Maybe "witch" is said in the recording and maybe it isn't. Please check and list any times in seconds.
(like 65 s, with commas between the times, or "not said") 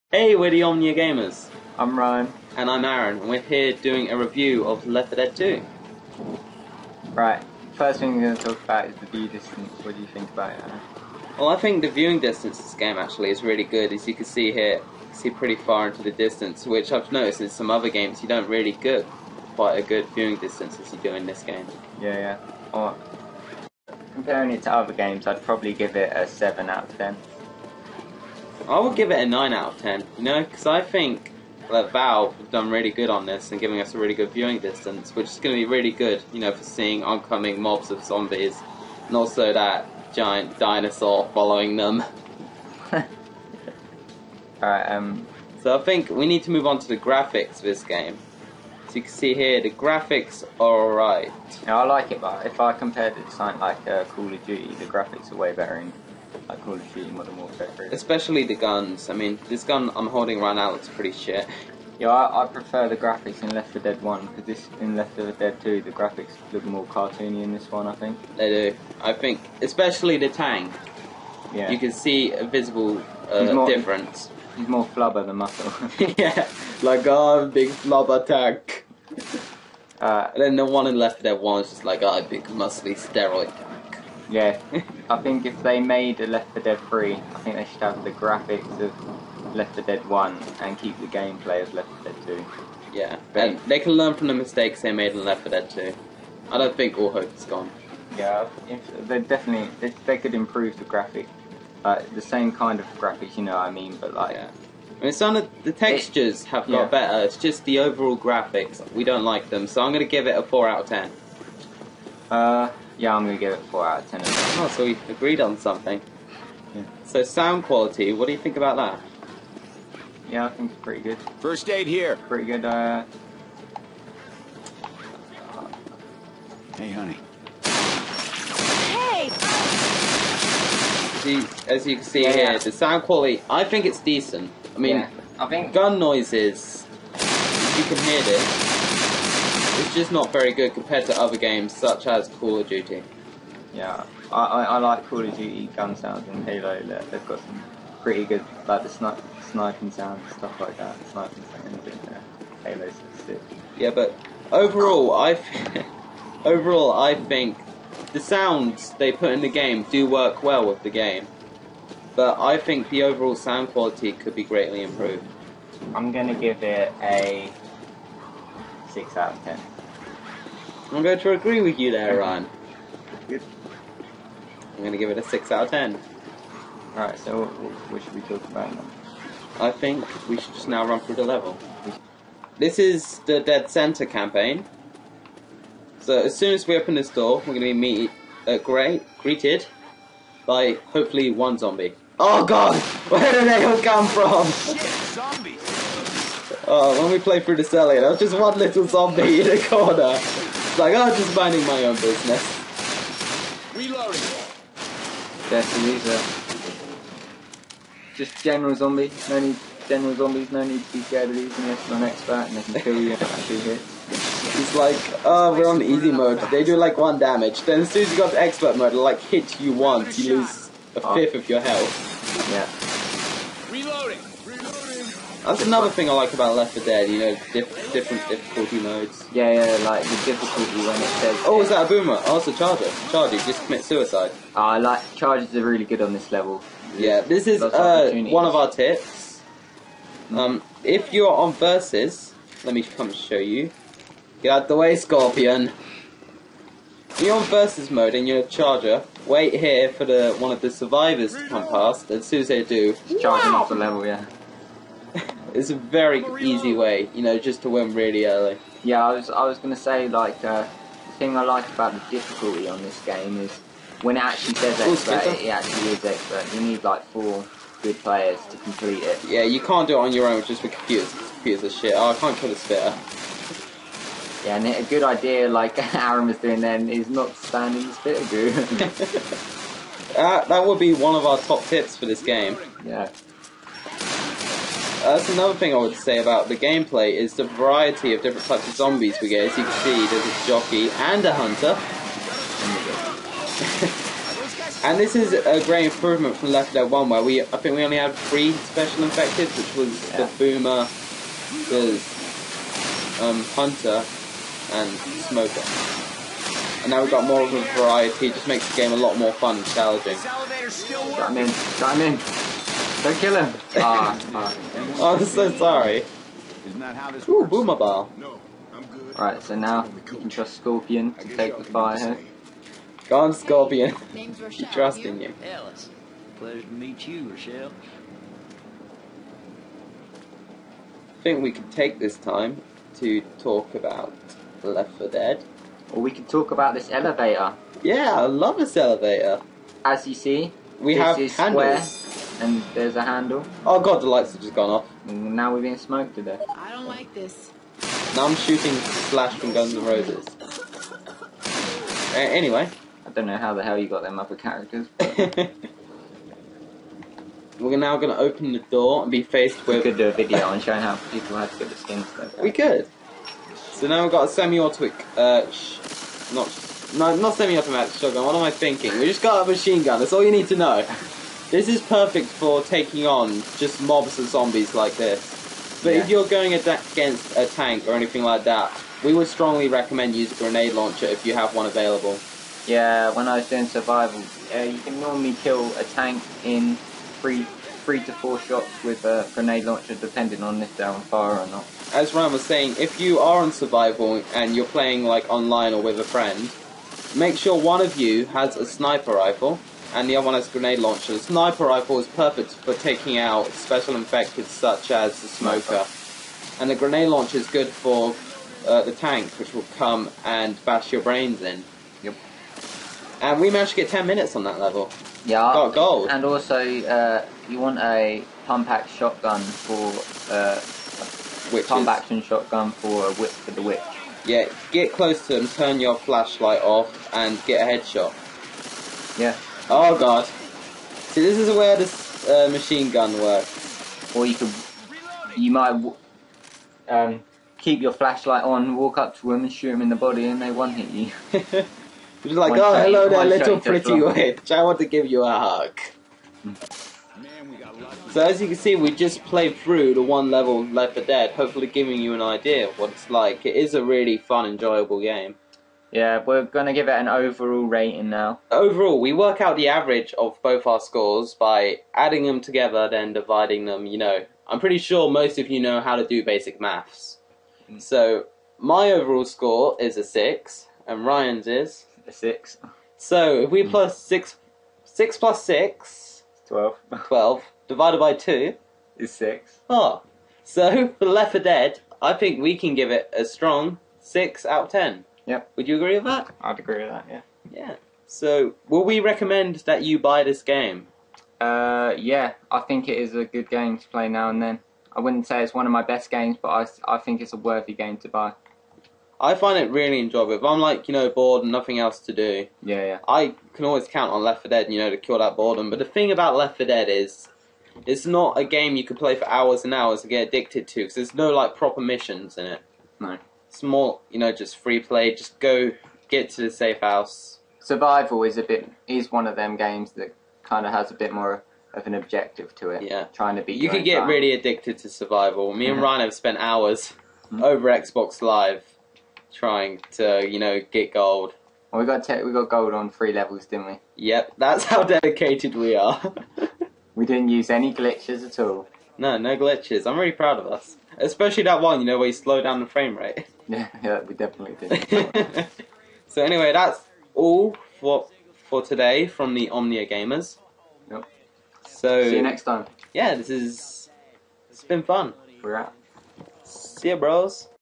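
423 s, 444 s.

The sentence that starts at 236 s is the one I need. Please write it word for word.
There's yeah, this is uh, one of our tips.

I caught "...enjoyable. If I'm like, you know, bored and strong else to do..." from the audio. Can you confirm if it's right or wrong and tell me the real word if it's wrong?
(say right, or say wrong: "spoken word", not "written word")
wrong: "nothing", not "strong".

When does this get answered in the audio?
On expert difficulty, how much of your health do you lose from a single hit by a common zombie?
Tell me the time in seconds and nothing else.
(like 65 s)
220 s.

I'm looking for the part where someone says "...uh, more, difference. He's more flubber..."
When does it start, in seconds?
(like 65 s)
73 s.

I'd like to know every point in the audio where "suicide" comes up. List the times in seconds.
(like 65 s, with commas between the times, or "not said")
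233 s.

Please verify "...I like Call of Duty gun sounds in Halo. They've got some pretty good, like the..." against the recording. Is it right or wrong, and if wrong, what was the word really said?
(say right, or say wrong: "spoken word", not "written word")
right.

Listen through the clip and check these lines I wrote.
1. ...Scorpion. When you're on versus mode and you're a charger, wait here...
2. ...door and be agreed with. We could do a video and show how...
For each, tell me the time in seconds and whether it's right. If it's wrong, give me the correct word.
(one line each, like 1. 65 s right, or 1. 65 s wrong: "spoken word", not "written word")
1. 244 s right
2. 358 s wrong: "faced", not "agreed".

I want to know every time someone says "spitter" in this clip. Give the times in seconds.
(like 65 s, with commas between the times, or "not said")
272 s, 277 s.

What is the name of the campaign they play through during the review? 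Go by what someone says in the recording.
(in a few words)
Dead Center.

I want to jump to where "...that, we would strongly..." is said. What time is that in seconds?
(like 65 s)
378 s.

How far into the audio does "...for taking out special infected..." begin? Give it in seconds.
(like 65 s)
402 s.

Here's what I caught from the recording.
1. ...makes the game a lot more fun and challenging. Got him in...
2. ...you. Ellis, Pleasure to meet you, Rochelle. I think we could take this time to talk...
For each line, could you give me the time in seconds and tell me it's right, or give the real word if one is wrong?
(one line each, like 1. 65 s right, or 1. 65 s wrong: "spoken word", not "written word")
1. 308 s right
2. 325 s right.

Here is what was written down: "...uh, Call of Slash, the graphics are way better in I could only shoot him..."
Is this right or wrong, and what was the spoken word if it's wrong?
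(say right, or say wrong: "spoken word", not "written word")
wrong: "Duty", not "Slash".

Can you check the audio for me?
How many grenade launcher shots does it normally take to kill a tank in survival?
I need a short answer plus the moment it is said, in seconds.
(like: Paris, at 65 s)
3 to 4, at 387 s.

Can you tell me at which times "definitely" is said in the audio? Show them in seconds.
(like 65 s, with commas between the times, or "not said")
99 s, 544 s.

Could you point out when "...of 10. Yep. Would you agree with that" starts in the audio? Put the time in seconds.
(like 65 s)
484 s.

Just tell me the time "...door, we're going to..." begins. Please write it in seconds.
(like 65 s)
187 s.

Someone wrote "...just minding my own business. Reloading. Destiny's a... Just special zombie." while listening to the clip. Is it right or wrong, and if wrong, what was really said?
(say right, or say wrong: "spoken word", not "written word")
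wrong: "general", not "special".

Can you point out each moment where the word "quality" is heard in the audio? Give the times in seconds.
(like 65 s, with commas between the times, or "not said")
117 s, 133 s, 163 s.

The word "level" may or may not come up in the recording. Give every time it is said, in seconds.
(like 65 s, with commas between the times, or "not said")
181 s, 236 s, 253 s, 414 s, 450 s, 533 s.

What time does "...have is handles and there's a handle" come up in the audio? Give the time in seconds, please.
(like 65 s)
340 s.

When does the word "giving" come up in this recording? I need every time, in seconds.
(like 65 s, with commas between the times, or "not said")
33 s, 451 s.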